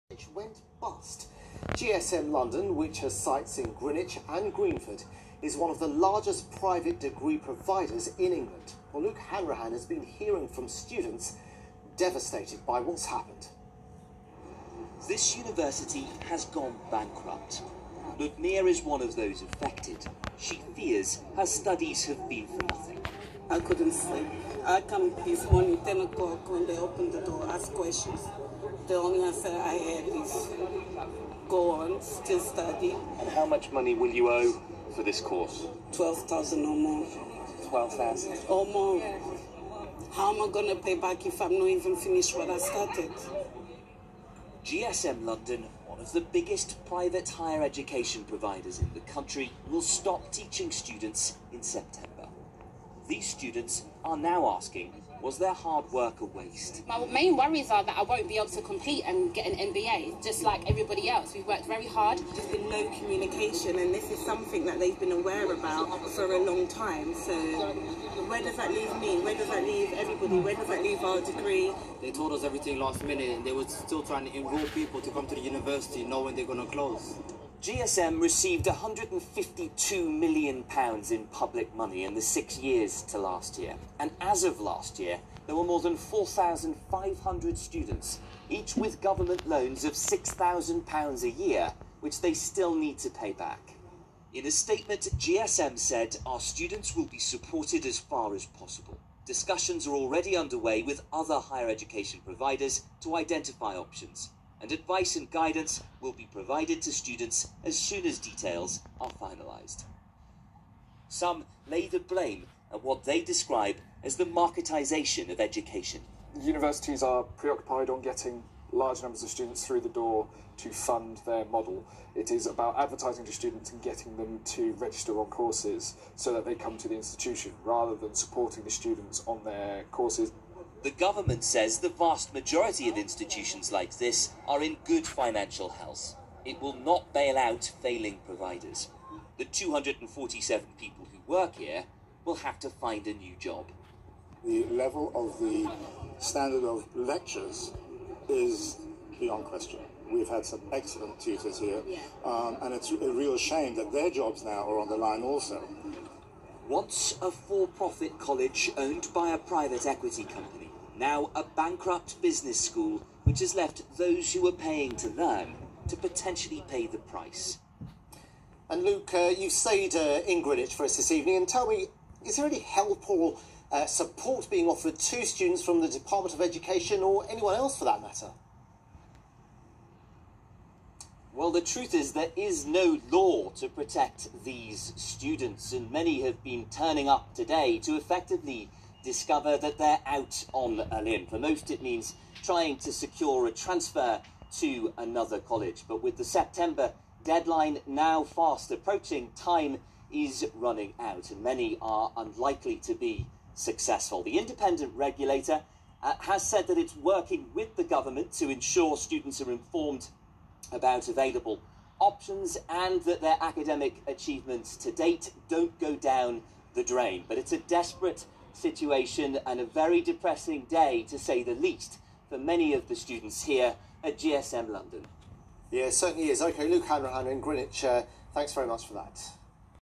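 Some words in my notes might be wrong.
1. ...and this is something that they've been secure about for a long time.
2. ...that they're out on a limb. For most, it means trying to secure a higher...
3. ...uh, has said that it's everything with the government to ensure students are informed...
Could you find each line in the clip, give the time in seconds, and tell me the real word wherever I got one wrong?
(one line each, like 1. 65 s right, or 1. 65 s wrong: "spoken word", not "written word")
1. 63 s wrong: "aware", not "secure"
2. 189 s wrong: "transfer", not "higher"
3. 206 s wrong: "working", not "everything".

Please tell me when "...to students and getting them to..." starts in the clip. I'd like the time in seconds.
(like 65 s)
123 s.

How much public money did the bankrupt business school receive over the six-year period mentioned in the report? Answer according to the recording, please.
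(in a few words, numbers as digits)
£152 million.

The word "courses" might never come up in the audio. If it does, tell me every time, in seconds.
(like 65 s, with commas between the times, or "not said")
35 s, 125 s, 129 s.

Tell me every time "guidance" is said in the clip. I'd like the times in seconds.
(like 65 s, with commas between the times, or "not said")
105 s.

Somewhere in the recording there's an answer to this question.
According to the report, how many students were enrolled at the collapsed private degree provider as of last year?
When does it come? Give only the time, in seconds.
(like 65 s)
85 s.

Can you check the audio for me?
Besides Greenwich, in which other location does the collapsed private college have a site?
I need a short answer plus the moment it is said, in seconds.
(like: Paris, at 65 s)
Greenford, at 4 s.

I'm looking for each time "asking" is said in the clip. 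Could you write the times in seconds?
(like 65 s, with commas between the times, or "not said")
54 s.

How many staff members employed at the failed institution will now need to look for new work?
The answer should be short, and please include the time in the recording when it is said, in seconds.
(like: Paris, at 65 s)
247, at 139 s.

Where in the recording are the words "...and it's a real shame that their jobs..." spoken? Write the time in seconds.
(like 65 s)
152 s.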